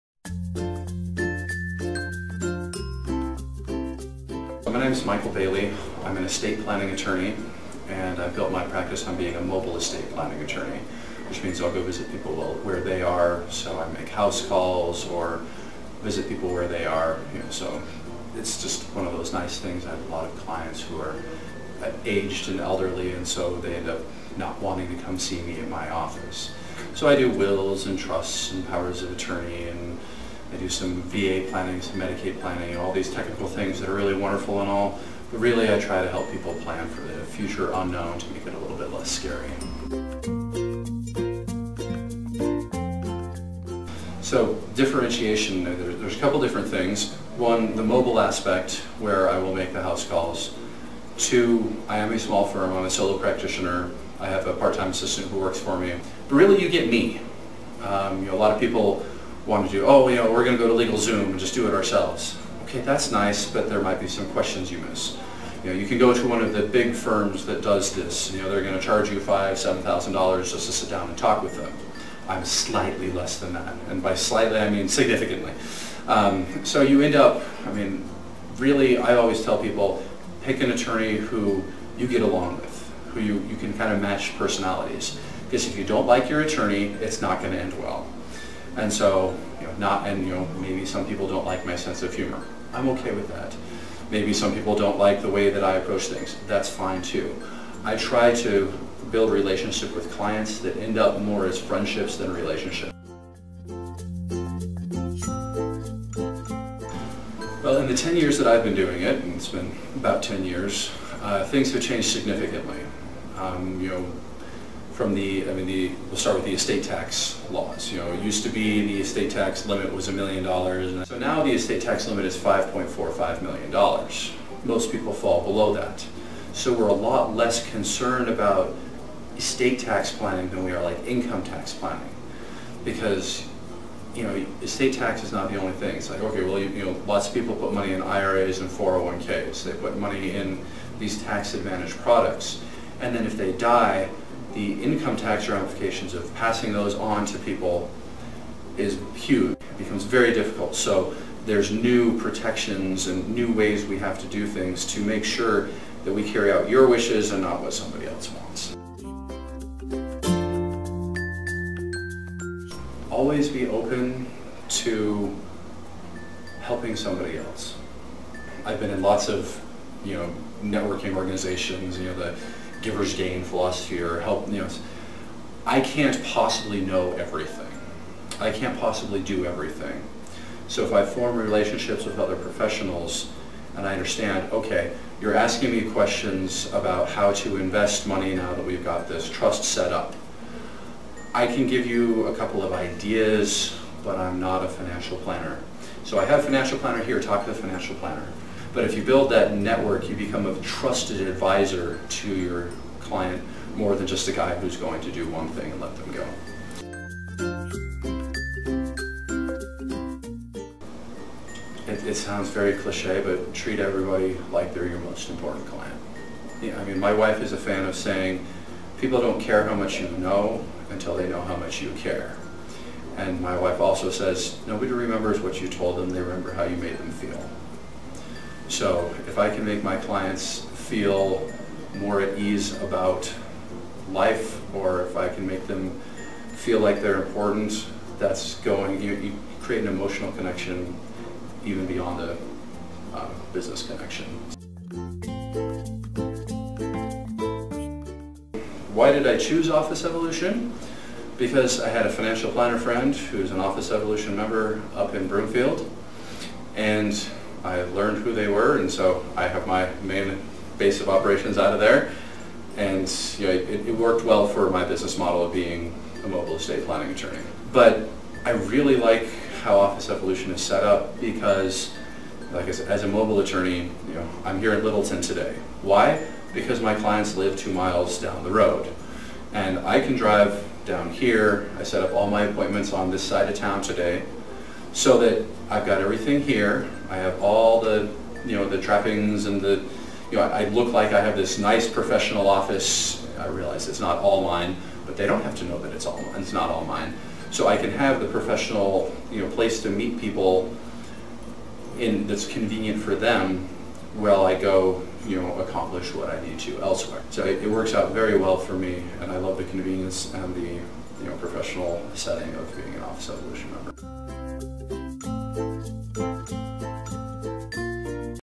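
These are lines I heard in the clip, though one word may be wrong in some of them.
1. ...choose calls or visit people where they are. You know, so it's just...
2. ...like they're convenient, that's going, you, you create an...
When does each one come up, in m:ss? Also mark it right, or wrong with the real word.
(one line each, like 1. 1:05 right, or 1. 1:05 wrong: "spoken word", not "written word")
1. 0:14 wrong: "house", not "choose"
2. 3:56 wrong: "important", not "convenient".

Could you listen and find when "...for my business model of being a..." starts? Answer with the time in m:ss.
4:24.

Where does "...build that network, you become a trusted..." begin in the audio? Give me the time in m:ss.
3:19.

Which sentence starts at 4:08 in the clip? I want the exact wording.
Why did I choose Office Evolution?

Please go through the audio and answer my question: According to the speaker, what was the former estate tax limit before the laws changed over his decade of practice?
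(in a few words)
$1 million.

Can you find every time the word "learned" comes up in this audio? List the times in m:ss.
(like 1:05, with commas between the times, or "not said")
4:17.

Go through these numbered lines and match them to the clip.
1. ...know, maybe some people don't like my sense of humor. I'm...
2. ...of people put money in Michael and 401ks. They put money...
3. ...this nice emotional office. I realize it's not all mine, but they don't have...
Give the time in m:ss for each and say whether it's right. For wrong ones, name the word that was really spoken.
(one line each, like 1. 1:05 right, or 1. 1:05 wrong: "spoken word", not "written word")
1. 1:30 right
2. 2:17 wrong: "IRAs", not "Michael"
3. 4:51 wrong: "professional", not "emotional".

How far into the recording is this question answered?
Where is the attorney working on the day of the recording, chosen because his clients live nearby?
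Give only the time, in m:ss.
4:34.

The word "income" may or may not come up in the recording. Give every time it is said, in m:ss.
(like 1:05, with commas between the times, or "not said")
2:11, 2:24.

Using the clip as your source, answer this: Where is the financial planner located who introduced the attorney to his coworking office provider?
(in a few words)
Broomfield.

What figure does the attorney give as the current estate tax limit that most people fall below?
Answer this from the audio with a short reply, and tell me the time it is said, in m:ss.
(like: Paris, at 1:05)
$5.45 million, at 2:02.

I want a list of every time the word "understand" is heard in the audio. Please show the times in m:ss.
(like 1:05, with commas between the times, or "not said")
3:03.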